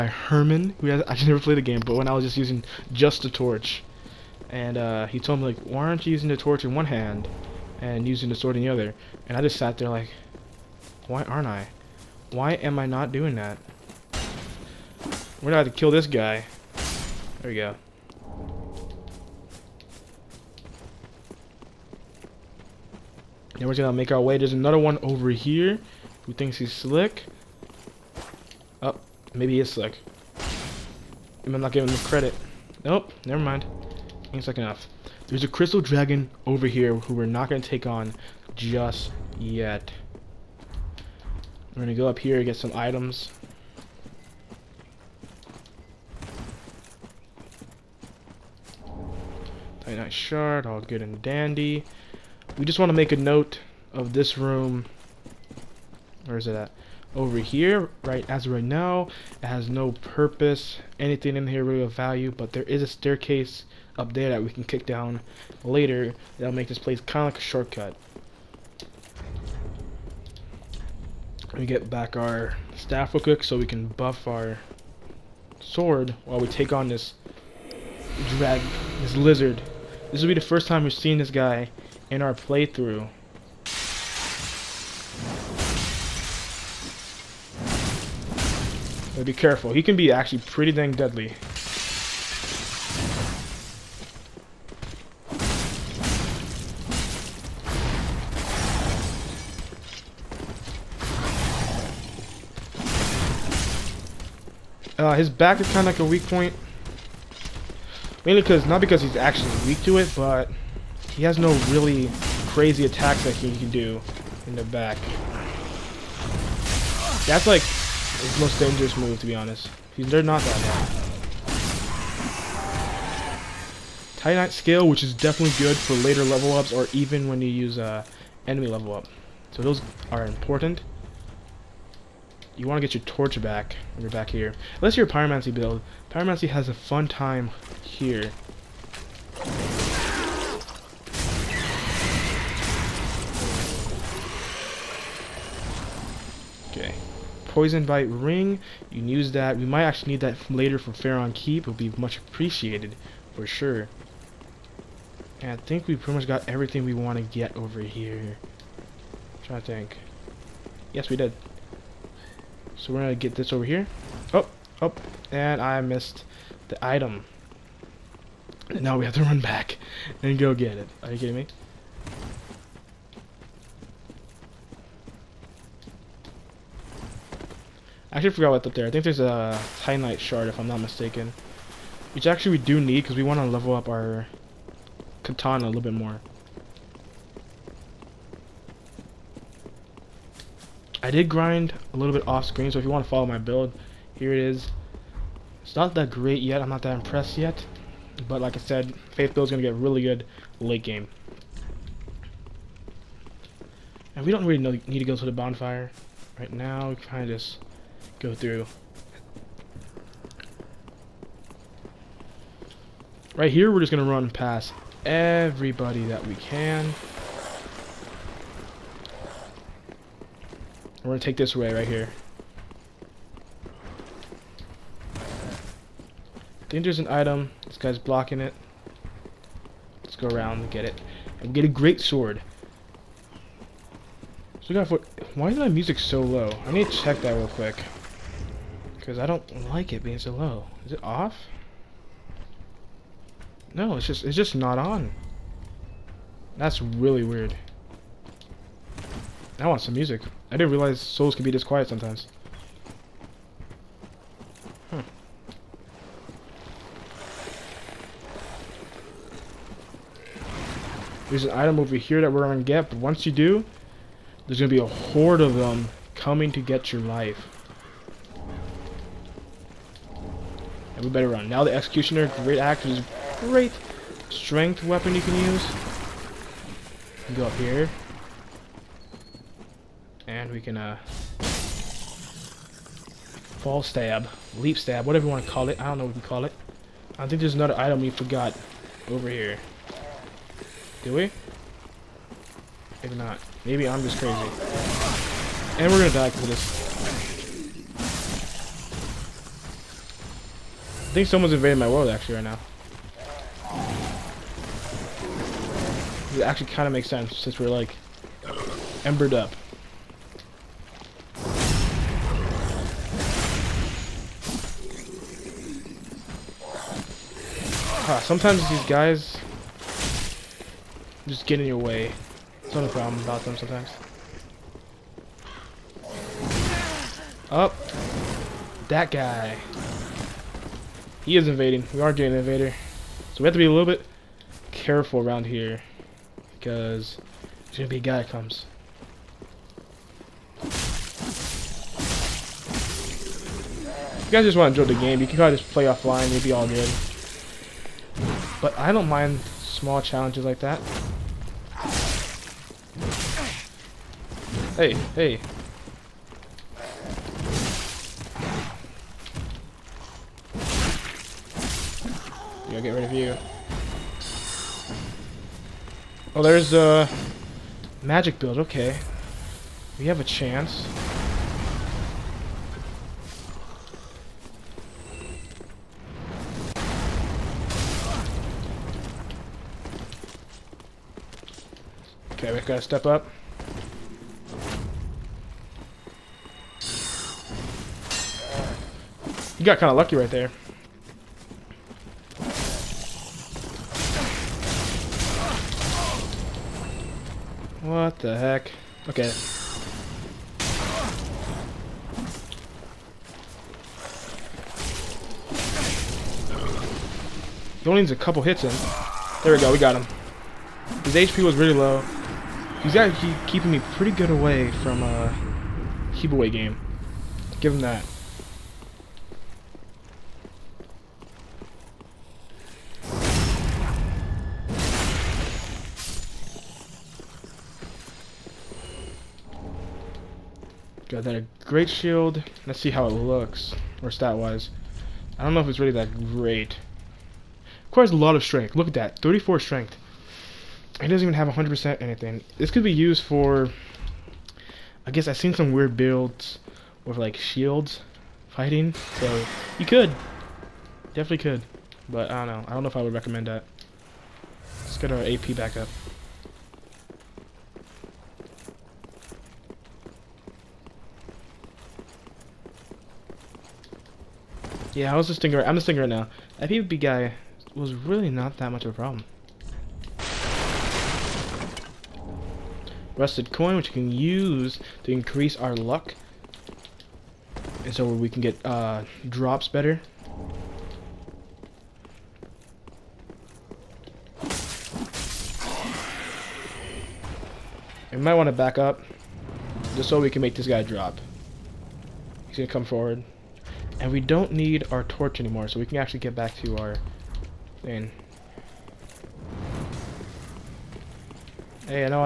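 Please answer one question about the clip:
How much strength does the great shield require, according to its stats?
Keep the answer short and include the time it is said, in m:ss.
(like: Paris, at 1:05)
34, at 7:19.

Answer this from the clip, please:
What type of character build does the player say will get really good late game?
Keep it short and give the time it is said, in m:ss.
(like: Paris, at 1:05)
Faith Build, at 3:19.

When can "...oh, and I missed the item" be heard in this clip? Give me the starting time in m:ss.
2:44.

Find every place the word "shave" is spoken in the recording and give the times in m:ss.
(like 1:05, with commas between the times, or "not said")
not said.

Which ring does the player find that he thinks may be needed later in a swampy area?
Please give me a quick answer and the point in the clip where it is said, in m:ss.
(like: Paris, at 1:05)
Poison Bite Ring, at 2:27.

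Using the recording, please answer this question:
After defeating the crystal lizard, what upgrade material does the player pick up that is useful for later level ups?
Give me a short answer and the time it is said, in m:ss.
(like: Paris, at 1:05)
Titanite scale, at 2:04.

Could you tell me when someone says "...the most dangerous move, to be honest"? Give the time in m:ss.
1:58.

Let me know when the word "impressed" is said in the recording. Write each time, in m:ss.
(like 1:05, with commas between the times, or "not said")
3:16.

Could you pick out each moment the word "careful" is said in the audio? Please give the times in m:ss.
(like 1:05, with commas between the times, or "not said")
1:29, 5:34.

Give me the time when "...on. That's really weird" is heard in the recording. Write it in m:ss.
4:04.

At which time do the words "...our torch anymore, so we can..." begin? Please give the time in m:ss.
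8:14.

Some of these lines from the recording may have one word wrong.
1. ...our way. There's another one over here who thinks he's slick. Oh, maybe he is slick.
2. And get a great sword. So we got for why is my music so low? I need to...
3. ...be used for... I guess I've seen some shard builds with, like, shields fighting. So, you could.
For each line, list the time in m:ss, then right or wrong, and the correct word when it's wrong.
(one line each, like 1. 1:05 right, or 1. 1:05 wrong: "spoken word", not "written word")
1. 0:24 right
2. 3:51 right
3. 7:22 wrong: "weird", not "shard".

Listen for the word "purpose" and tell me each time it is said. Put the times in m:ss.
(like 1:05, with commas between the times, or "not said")
0:59.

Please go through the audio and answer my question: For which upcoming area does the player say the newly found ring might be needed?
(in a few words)
Farron Keep.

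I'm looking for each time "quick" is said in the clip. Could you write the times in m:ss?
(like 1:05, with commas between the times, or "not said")
1:13, 3:57.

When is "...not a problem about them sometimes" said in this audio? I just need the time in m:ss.
5:22.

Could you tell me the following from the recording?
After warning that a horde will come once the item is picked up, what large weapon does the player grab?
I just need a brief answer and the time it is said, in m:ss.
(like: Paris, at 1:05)
Executioner Greataxe, at 4:31.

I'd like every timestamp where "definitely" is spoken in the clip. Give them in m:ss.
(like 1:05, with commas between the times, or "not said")
2:05, 7:31.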